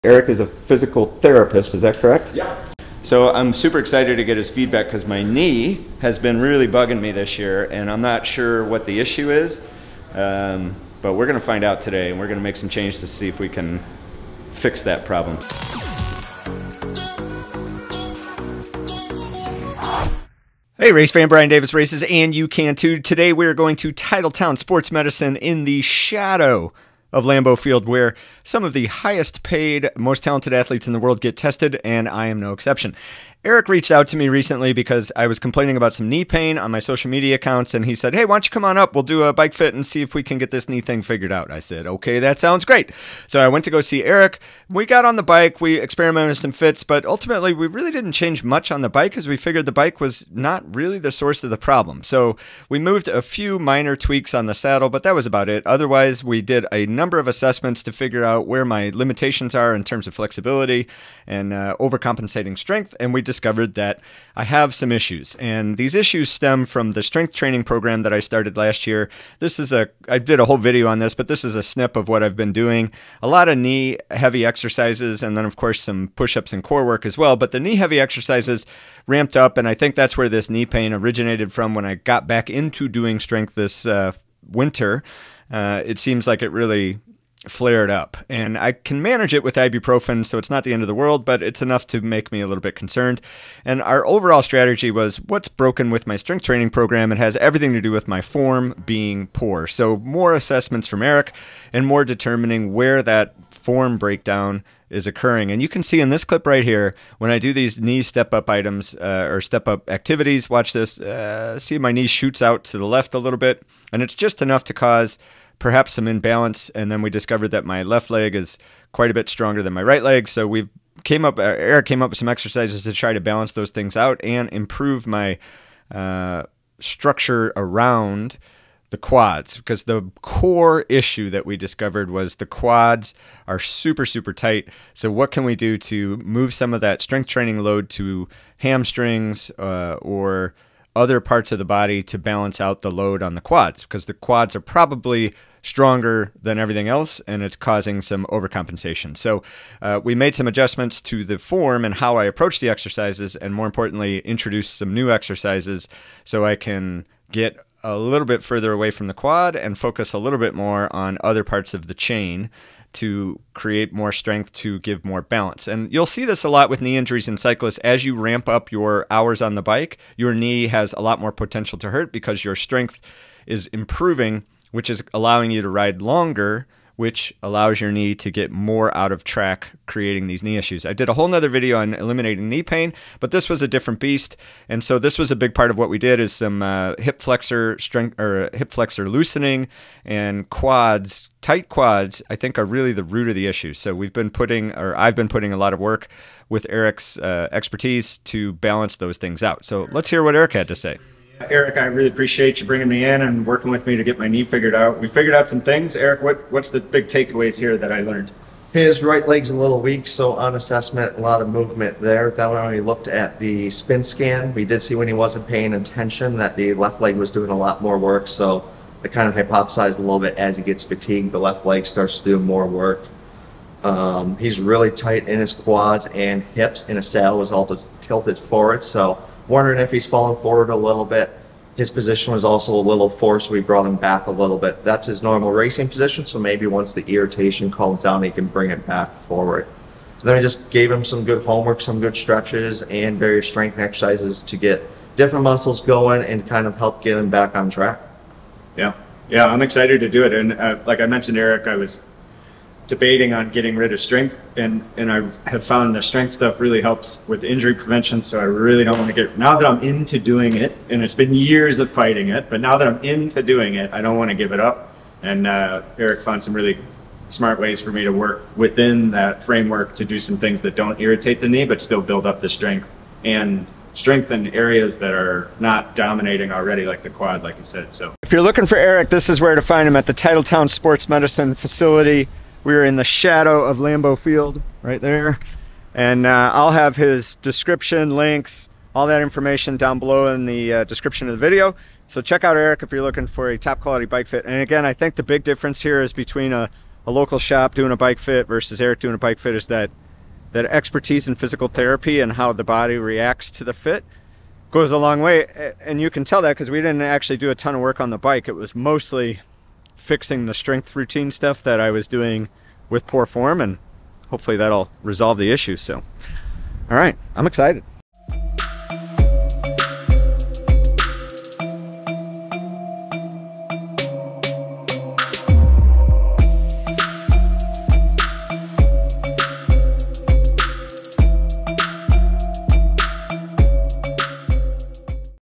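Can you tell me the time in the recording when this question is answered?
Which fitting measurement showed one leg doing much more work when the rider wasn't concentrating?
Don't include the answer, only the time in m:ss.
3:33.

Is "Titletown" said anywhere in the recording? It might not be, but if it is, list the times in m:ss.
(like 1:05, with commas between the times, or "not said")
0:23, 4:40.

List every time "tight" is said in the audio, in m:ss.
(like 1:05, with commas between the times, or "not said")
2:14, 3:11, 3:44.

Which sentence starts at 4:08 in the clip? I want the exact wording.
Yeah, yeah, I'm excited to do it.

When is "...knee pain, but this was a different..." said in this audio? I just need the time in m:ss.
3:02.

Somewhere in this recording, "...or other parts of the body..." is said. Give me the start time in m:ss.
2:20.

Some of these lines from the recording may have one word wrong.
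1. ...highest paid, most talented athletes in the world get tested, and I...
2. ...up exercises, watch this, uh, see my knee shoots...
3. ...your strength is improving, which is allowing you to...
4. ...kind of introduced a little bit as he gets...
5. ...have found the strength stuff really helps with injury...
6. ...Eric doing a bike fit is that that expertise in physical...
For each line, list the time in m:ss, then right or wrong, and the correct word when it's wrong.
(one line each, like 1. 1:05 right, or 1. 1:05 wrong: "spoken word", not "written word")
1. 0:28 right
2. 1:49 wrong: "activities", not "exercises"
3. 2:52 right
4. 3:39 wrong: "hypothesized", not "introduced"
5. 4:15 right
6. 4:58 right.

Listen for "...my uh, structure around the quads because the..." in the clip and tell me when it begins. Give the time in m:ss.
2:05.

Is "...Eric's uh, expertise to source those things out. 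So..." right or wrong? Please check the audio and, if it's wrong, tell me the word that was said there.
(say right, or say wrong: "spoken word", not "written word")
wrong: "balance", not "source".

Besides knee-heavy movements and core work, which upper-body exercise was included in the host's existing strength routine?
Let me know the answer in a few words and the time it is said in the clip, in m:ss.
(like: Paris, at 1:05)
push-ups, at 1:16.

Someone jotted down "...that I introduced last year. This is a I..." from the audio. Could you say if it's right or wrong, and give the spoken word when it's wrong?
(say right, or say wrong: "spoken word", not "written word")
wrong: "started", not "introduced".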